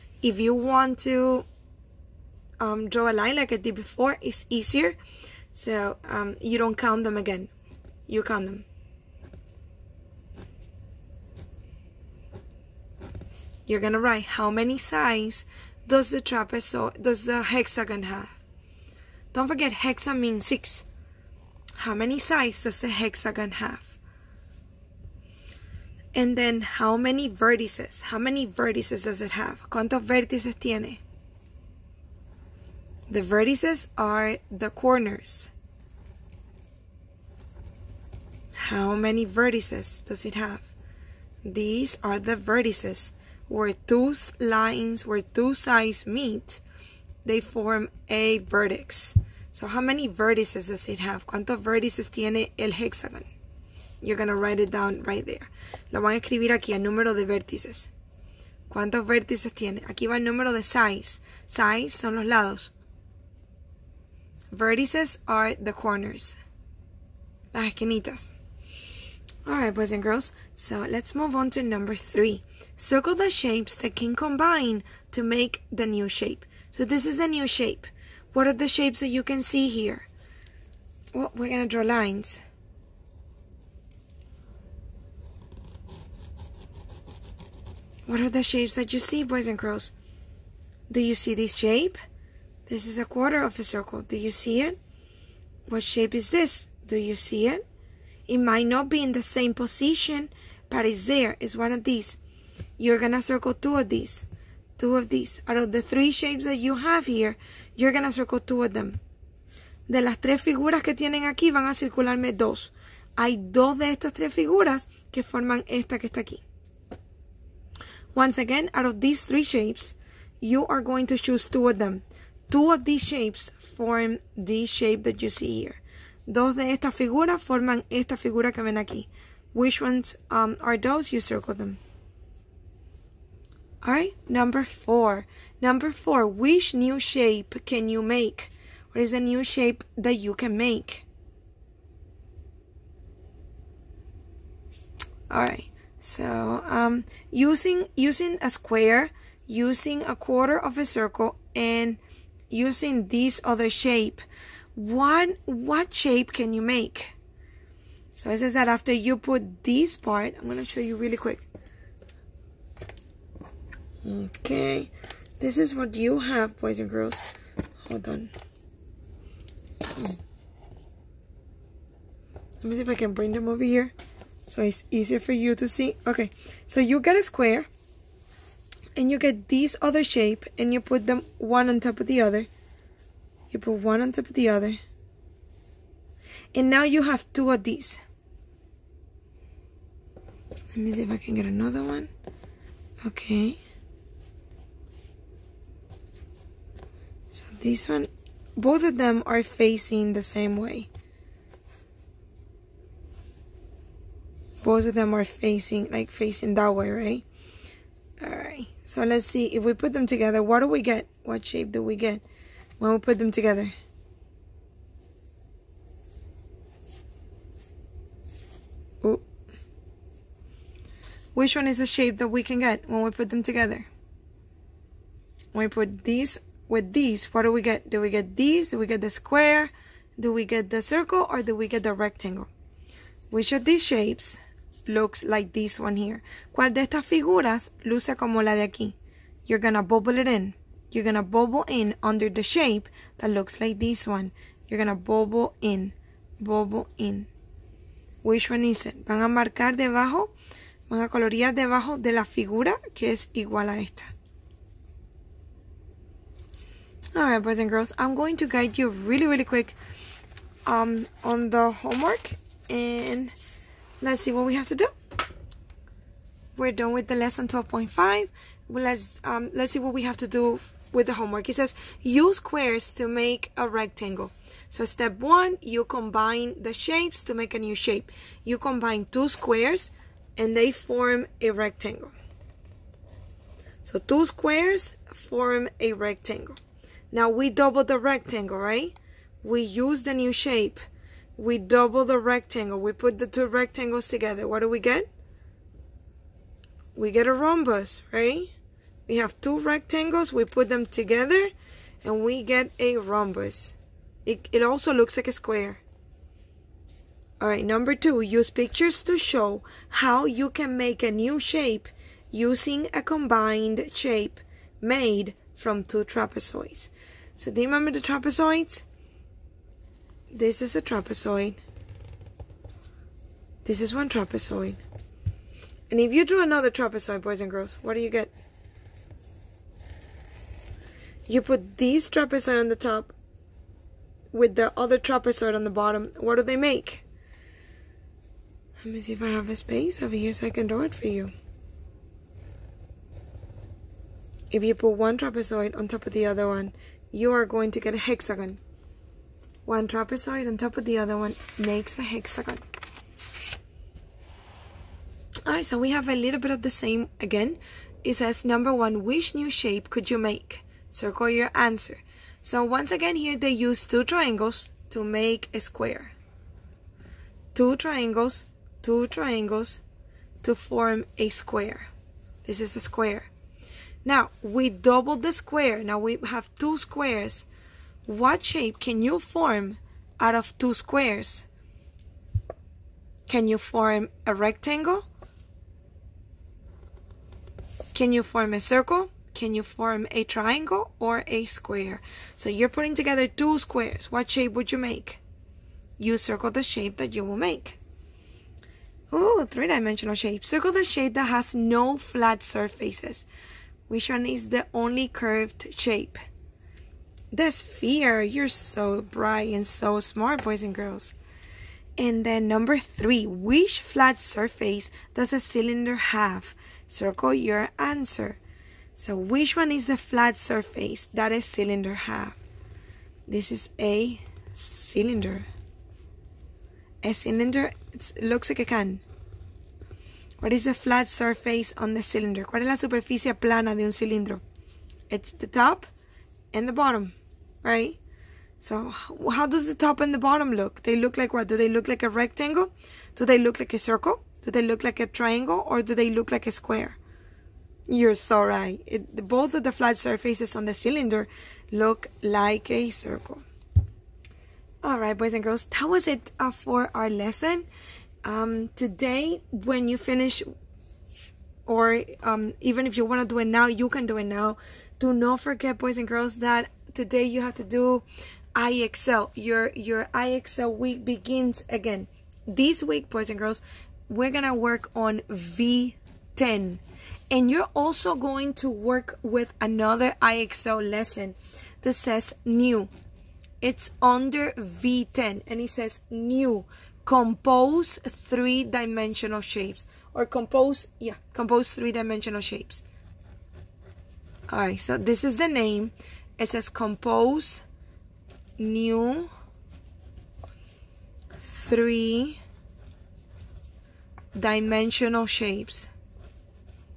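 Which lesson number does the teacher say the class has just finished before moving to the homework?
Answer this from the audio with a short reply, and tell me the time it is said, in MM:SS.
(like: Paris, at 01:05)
12.5, at 04:27.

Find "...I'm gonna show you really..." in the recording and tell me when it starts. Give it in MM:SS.
02:40.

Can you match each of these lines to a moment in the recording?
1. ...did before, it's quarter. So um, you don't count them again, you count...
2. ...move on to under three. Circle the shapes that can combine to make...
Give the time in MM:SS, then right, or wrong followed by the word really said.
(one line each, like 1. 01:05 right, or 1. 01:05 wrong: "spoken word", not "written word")
1. 00:03 wrong: "easier", not "quarter"
2. 01:11 wrong: "number", not "under".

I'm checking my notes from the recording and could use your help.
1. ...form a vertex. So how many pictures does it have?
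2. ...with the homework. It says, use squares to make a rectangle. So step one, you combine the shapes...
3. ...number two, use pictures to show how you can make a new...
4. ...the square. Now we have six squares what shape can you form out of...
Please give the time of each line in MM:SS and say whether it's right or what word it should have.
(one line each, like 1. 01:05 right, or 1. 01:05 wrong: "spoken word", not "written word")
1. 00:47 wrong: "vertices", not "pictures"
2. 04:30 right
3. 05:07 right
4. 06:15 wrong: "two", not "six".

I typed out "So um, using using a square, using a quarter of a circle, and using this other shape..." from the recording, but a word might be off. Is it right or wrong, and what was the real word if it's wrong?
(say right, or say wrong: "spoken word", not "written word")
right.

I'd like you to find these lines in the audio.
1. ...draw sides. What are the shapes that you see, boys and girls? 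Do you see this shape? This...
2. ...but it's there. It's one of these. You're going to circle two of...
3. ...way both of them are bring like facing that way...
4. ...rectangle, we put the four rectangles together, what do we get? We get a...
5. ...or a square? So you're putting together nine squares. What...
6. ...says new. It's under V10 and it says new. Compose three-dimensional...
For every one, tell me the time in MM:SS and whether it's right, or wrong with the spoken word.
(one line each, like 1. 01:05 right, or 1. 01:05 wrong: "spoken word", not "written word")
1. 01:21 wrong: "lines", not "sides"
2. 01:40 right
3. 03:20 wrong: "facing", not "bring"
4. 04:52 wrong: "two", not "four"
5. 06:30 wrong: "two", not "nine"
6. 08:01 right.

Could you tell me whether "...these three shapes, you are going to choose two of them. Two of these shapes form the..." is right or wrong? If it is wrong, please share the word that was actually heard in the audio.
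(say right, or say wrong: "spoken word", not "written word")
right.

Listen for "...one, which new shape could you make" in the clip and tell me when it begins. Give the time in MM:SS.
05:58.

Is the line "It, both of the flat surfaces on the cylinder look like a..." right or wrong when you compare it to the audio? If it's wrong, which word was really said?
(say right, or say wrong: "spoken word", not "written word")
right.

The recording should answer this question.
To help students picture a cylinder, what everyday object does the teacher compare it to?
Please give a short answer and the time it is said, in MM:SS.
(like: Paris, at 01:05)
a can, at 07:08.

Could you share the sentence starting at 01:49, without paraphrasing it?
De las tres figuras que tienen aquí, van a circularme dos.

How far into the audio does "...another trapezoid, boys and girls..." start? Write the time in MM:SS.
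05:26.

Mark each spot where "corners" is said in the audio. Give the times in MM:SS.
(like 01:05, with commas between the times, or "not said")
00:34, 01:05.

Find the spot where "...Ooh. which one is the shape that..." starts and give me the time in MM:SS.
03:39.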